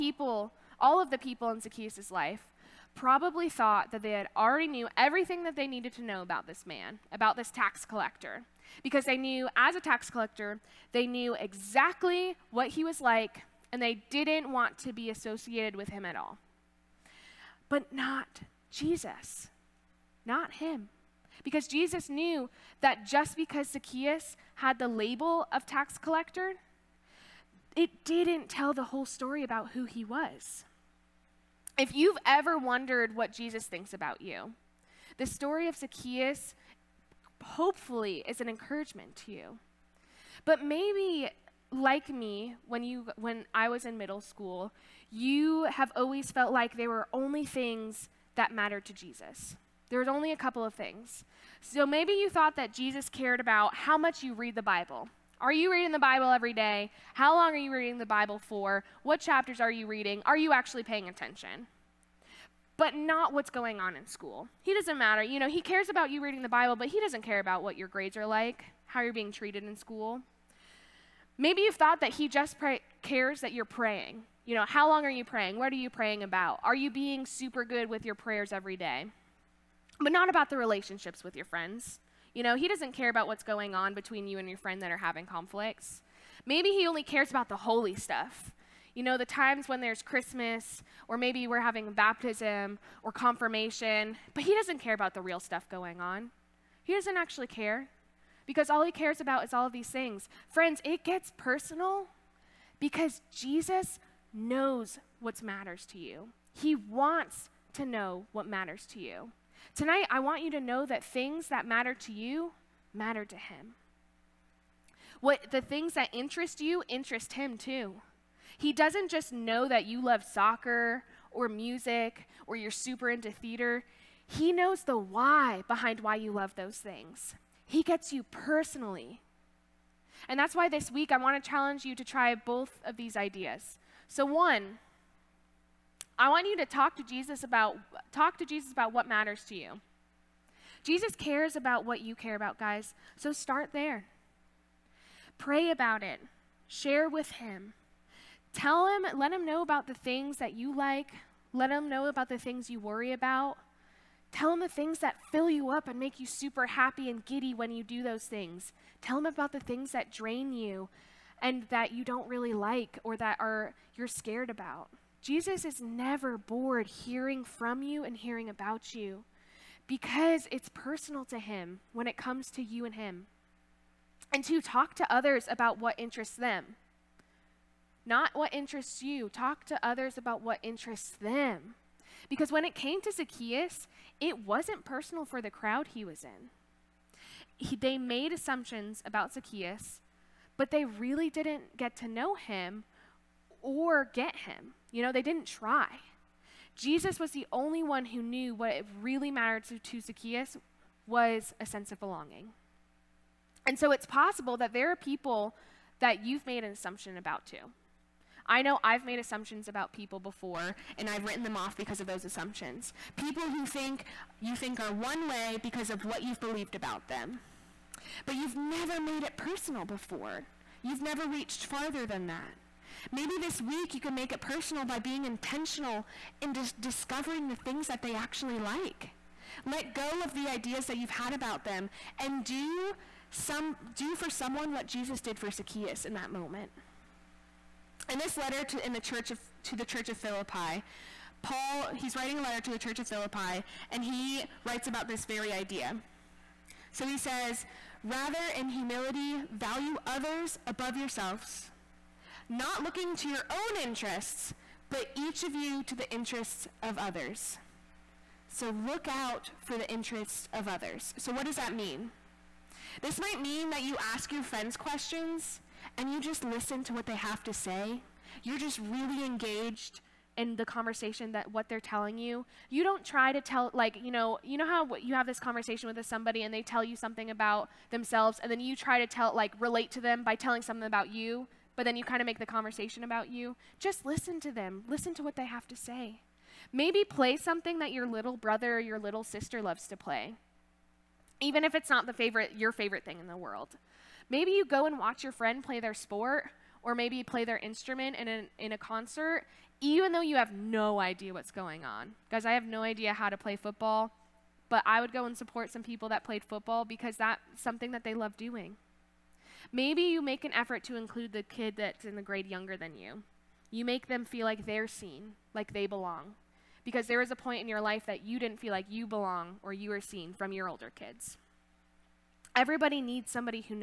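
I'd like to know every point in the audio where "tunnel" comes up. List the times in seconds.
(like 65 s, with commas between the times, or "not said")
not said.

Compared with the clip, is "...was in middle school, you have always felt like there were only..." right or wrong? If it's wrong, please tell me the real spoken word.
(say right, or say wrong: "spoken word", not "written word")
right.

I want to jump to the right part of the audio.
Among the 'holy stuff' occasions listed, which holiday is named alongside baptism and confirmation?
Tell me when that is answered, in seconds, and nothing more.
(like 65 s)
90 s.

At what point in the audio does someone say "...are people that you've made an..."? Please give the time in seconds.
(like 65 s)
204 s.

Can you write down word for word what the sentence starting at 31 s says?
If you've ever wondered what Jesus thinks about you, the story of Zacchaeus hopefully is an encouragement to you.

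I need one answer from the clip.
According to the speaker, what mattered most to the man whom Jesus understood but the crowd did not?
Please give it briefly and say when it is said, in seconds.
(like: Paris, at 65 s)
a sense of belonging, at 201 s.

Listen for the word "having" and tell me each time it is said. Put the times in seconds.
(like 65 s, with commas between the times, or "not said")
84 s, 91 s.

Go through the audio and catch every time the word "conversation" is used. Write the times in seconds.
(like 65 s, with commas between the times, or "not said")
270 s, 275 s, 282 s.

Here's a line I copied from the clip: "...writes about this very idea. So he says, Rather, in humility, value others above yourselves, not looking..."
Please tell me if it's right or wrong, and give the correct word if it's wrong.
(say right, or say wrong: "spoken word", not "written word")
right.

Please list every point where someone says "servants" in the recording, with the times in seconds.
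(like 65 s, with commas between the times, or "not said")
not said.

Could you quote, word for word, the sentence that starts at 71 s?
Maybe you've thought that he just pray- cares that you're praying, you know, how long are you praying?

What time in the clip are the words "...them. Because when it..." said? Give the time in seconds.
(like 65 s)
181 s.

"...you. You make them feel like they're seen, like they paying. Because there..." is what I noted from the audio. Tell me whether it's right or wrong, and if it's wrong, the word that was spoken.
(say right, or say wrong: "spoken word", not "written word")
wrong: "belong", not "paying".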